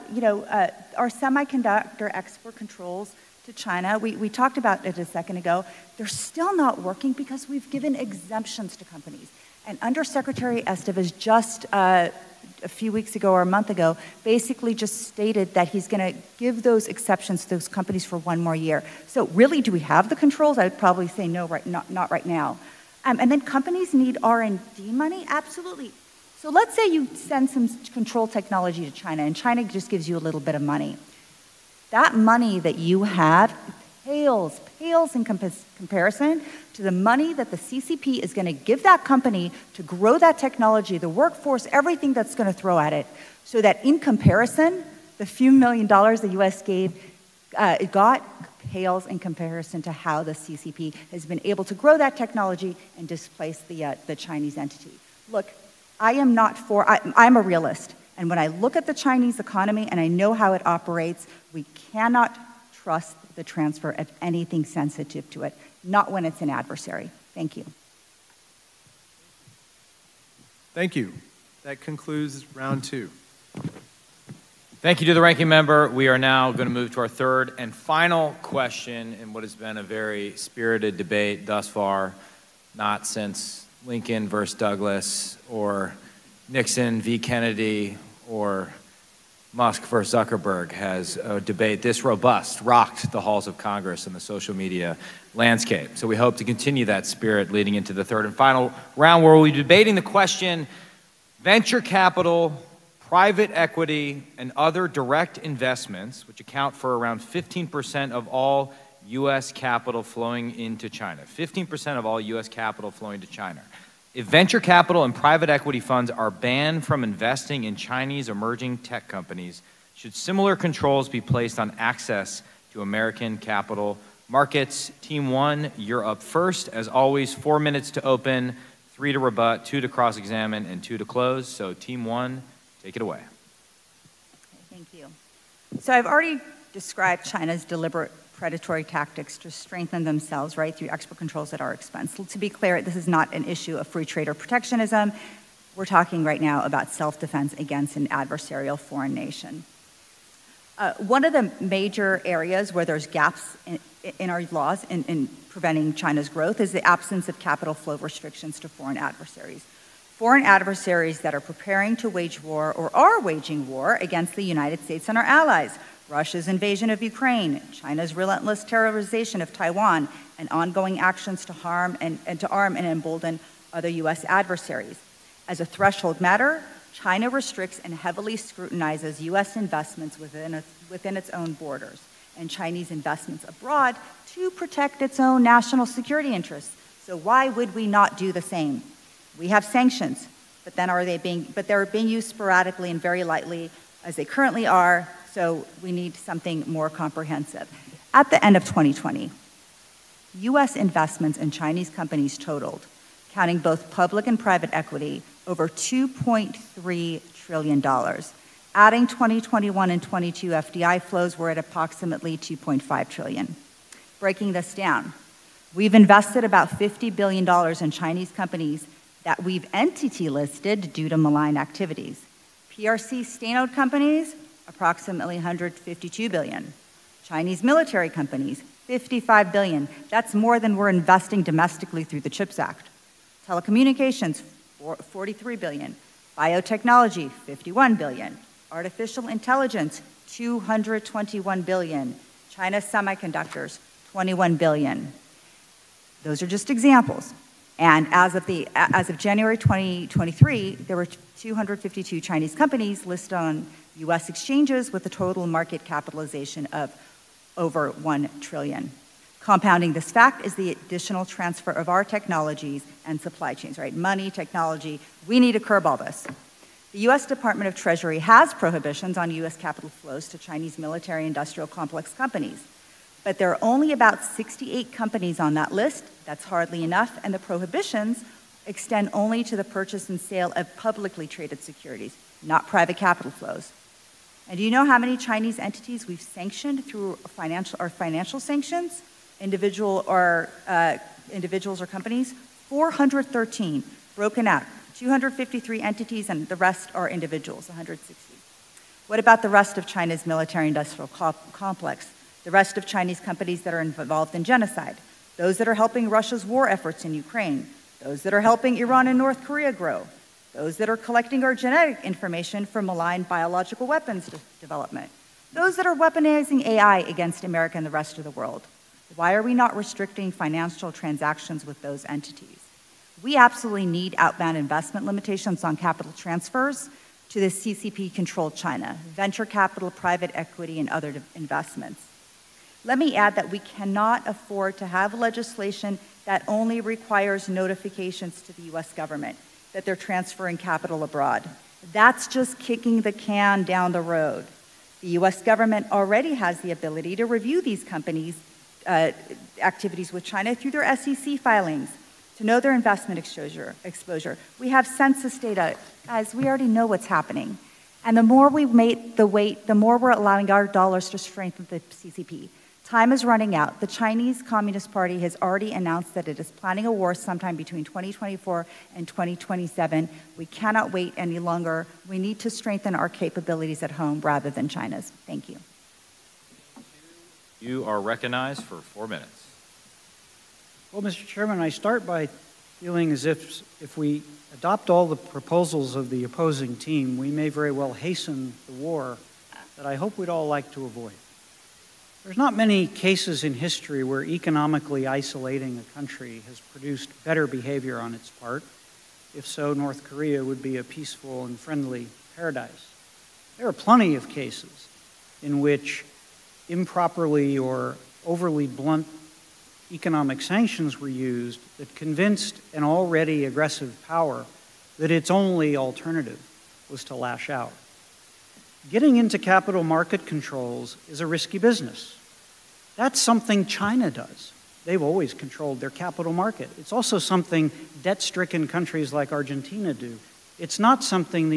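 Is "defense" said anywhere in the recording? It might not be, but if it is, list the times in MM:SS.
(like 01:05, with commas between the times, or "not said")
02:27.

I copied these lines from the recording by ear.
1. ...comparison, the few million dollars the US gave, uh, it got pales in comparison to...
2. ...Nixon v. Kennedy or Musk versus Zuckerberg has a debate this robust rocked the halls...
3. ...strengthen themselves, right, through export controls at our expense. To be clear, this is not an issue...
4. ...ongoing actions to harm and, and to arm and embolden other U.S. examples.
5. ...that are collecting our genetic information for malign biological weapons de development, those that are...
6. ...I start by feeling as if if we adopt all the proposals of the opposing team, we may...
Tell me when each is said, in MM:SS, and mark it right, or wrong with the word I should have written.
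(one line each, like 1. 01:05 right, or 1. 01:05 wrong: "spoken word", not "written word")
1. 00:43 right
2. 01:26 right
3. 02:19 right
4. 02:50 wrong: "adversaries", not "examples"
5. 05:10 right
6. 06:21 right.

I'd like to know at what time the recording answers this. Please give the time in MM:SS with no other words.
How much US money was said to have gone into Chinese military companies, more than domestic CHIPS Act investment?
03:48.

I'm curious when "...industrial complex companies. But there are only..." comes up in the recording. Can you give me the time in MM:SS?
04:31.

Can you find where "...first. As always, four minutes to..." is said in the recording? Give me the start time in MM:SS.
02:06.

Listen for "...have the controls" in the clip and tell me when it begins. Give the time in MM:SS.
00:19.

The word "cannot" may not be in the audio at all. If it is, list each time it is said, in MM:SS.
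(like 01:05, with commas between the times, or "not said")
01:01, 05:33, 06:10.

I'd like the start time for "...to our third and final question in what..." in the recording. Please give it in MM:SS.
01:16.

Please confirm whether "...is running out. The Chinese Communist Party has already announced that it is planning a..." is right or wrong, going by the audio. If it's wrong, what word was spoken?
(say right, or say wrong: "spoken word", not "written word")
right.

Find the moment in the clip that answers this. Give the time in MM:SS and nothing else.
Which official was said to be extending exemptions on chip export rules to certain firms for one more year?
00:09.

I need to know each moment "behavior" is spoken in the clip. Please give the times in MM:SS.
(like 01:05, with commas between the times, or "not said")
06:37.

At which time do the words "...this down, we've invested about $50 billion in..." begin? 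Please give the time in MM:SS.
03:34.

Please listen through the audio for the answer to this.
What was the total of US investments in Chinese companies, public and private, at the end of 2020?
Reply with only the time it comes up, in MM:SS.
03:25.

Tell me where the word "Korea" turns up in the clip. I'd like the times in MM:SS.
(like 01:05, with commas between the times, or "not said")
05:09, 06:40.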